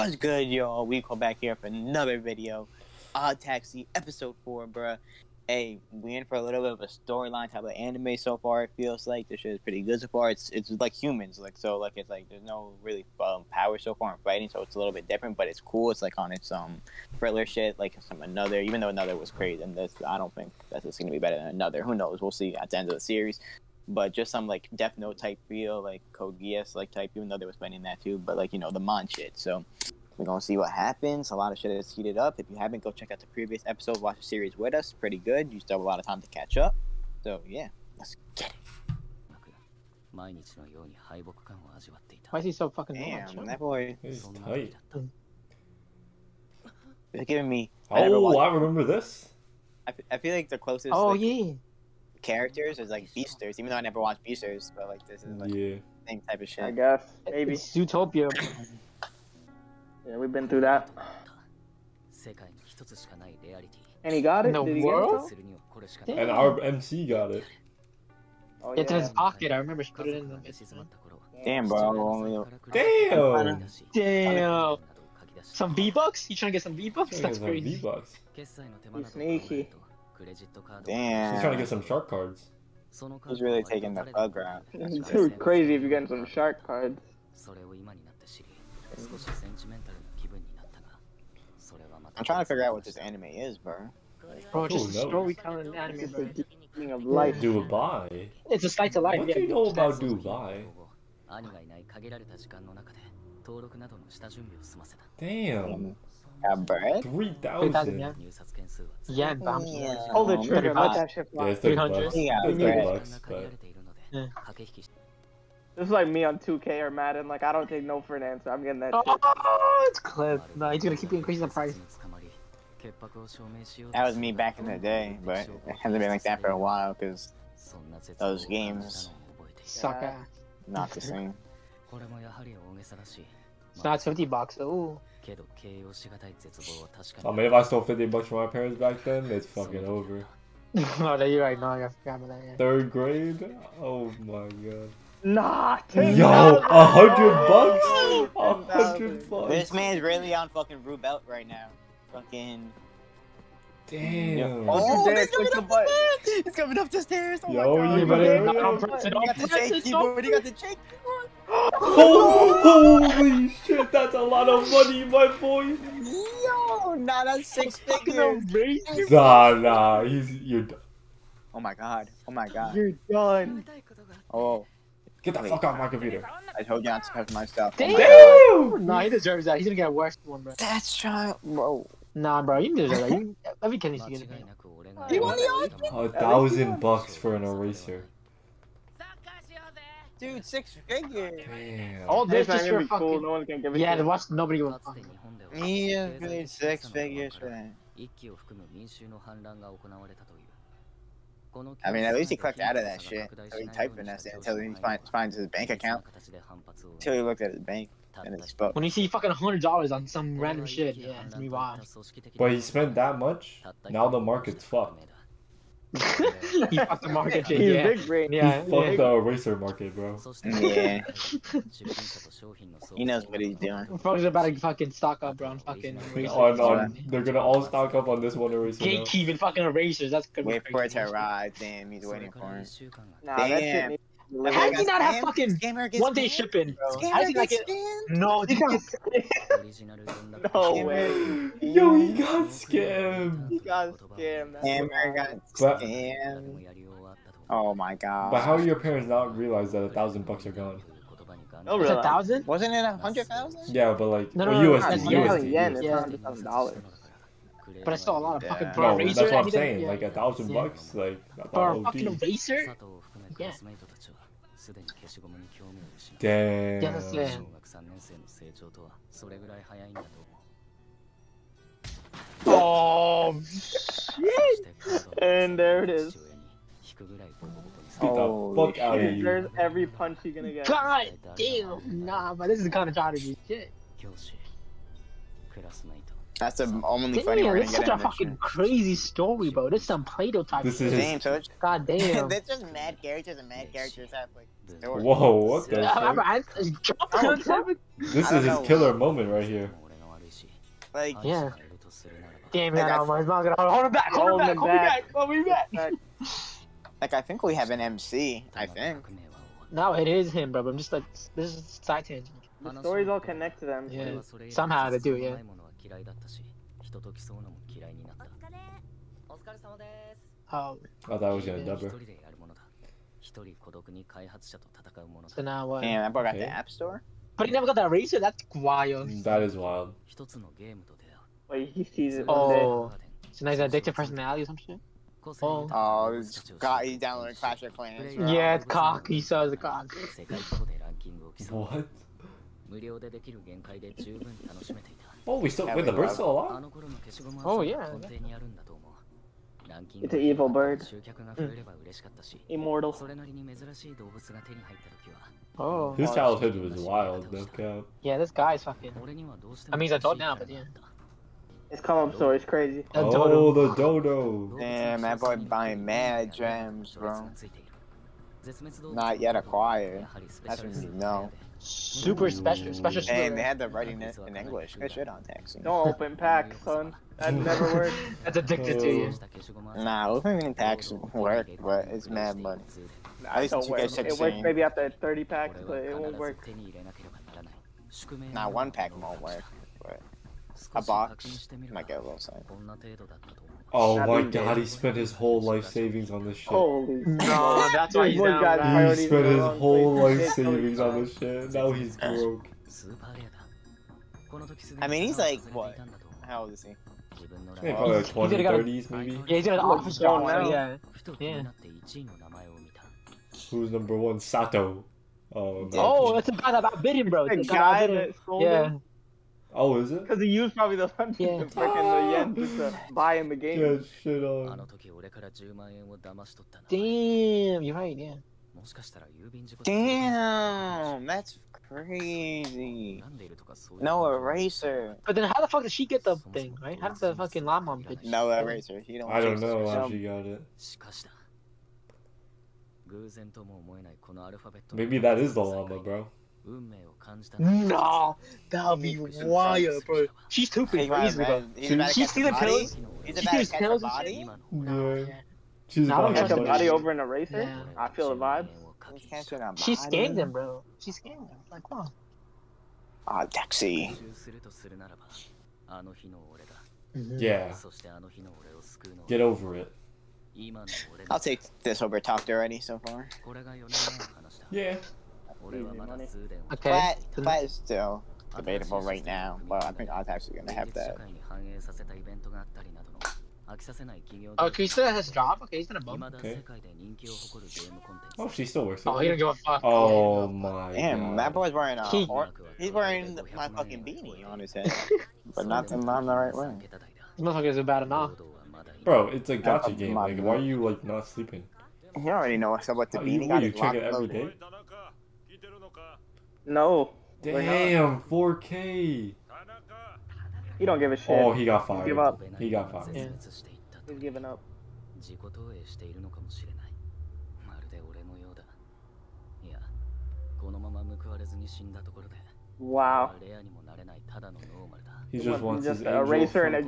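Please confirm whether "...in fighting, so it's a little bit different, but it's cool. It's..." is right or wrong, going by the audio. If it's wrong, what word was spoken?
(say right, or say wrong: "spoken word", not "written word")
right.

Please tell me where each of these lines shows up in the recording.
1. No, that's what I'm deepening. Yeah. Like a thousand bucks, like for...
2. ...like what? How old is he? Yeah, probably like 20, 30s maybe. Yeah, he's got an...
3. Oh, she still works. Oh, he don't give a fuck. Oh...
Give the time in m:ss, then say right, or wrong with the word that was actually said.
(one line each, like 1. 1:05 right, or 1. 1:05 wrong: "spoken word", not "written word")
1. 4:18 wrong: "saying", not "deepening"
2. 6:45 right
3. 8:08 right.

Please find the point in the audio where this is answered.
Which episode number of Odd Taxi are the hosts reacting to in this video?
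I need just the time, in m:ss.
0:03.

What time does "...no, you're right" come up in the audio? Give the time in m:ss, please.
2:20.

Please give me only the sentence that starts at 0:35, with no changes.
You still have a lot of time to catch up.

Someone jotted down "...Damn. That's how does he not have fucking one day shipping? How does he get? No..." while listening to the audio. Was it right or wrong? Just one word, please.
right.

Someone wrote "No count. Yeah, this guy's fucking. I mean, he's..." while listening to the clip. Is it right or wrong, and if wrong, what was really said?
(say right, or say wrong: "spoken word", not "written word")
right.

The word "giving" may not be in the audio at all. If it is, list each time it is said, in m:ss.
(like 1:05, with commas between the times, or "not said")
0:47, 8:33.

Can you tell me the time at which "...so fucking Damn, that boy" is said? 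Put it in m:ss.
0:42.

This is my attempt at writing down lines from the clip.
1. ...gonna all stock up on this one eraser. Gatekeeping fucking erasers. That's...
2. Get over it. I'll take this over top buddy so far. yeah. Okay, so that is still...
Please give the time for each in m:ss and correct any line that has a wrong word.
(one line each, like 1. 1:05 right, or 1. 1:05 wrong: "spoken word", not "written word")
1. 3:47 right
2. 7:49 wrong: "already", not "buddy".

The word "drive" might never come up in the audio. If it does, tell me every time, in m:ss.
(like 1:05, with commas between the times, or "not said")
not said.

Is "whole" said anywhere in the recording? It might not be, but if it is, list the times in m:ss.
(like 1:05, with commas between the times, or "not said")
6:35, 6:39.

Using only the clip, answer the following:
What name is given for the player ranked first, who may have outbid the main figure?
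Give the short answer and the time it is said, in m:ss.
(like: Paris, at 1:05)
Sato, at 6:54.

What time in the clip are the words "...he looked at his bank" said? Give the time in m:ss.
3:27.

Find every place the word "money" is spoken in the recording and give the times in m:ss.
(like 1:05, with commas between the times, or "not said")
2:44, 6:22.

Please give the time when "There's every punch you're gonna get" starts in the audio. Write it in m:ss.
4:39.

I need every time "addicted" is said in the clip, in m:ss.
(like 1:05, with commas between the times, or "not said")
5:33, 6:18.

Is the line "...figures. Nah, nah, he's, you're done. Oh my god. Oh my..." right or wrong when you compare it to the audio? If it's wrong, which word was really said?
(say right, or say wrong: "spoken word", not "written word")
right.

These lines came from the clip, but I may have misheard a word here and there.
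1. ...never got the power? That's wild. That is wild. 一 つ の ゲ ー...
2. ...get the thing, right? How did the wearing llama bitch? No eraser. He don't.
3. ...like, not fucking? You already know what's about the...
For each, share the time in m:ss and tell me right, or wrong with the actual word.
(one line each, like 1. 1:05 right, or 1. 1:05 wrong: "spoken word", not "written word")
1. 5:27 wrong: "eraser", not "power"
2. 7:15 wrong: "fucking", not "wearing"
3. 8:20 wrong: "sleeping", not "fucking".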